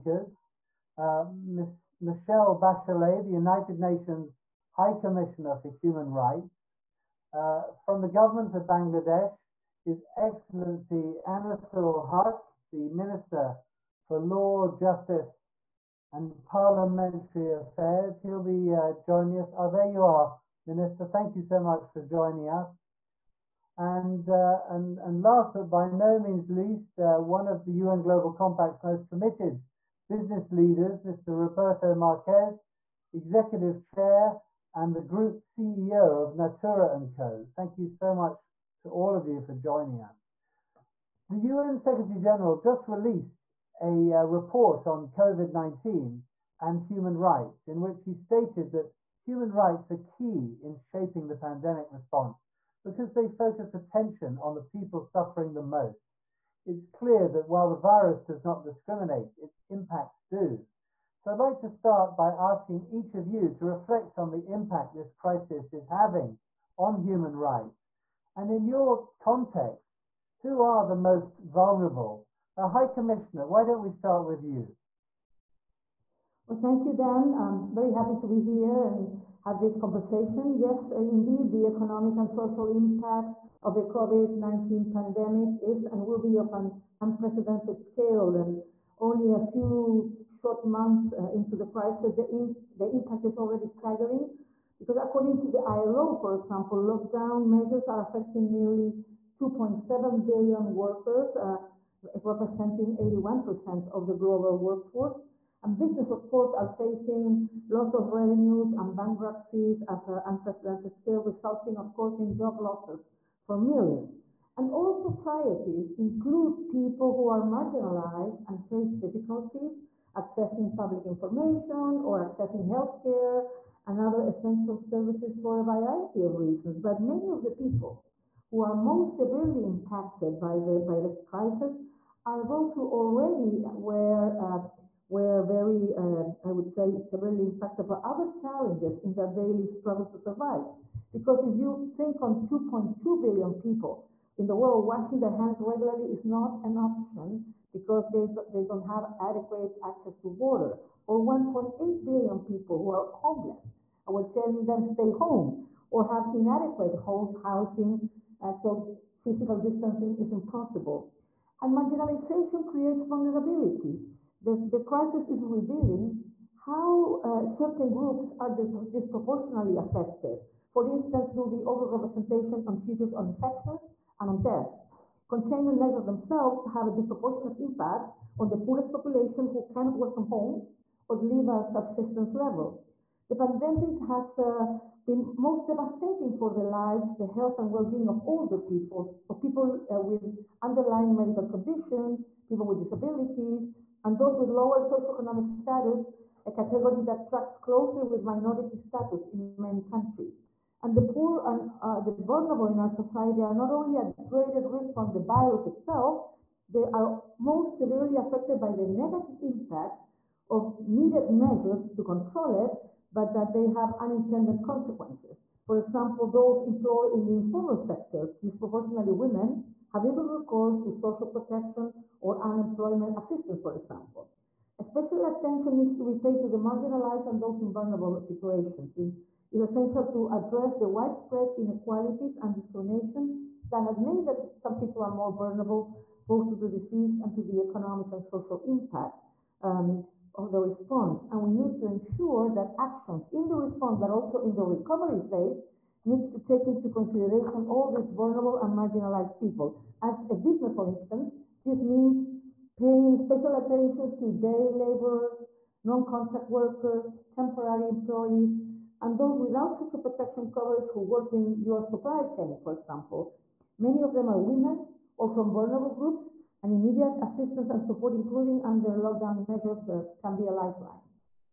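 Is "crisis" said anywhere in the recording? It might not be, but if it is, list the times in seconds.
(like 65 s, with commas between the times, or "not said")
65 s, 91 s, 131 s, 164 s.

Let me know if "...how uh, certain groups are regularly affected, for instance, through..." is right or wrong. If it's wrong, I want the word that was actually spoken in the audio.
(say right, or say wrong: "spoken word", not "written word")
wrong: "disproportionately", not "regularly".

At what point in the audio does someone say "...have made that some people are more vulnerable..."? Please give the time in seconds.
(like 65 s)
233 s.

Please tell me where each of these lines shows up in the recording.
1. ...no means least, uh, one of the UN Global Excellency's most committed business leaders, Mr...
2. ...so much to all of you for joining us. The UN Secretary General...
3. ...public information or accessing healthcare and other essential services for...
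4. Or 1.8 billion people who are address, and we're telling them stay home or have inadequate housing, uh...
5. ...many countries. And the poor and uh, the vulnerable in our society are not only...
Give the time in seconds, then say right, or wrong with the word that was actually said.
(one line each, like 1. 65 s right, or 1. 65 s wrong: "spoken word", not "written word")
1. 25 s wrong: "Compact", not "Excellency"
2. 37 s right
3. 120 s right
4. 151 s wrong: "homeless", not "address"
5. 199 s right.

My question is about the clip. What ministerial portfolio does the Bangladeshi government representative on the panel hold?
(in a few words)
Law, Justice and Parliamentary Affairs.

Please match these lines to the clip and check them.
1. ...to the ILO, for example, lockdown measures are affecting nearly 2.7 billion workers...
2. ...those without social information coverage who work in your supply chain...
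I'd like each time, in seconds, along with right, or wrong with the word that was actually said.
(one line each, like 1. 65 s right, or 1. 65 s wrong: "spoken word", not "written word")
1. 95 s right
2. 259 s wrong: "protection", not "information".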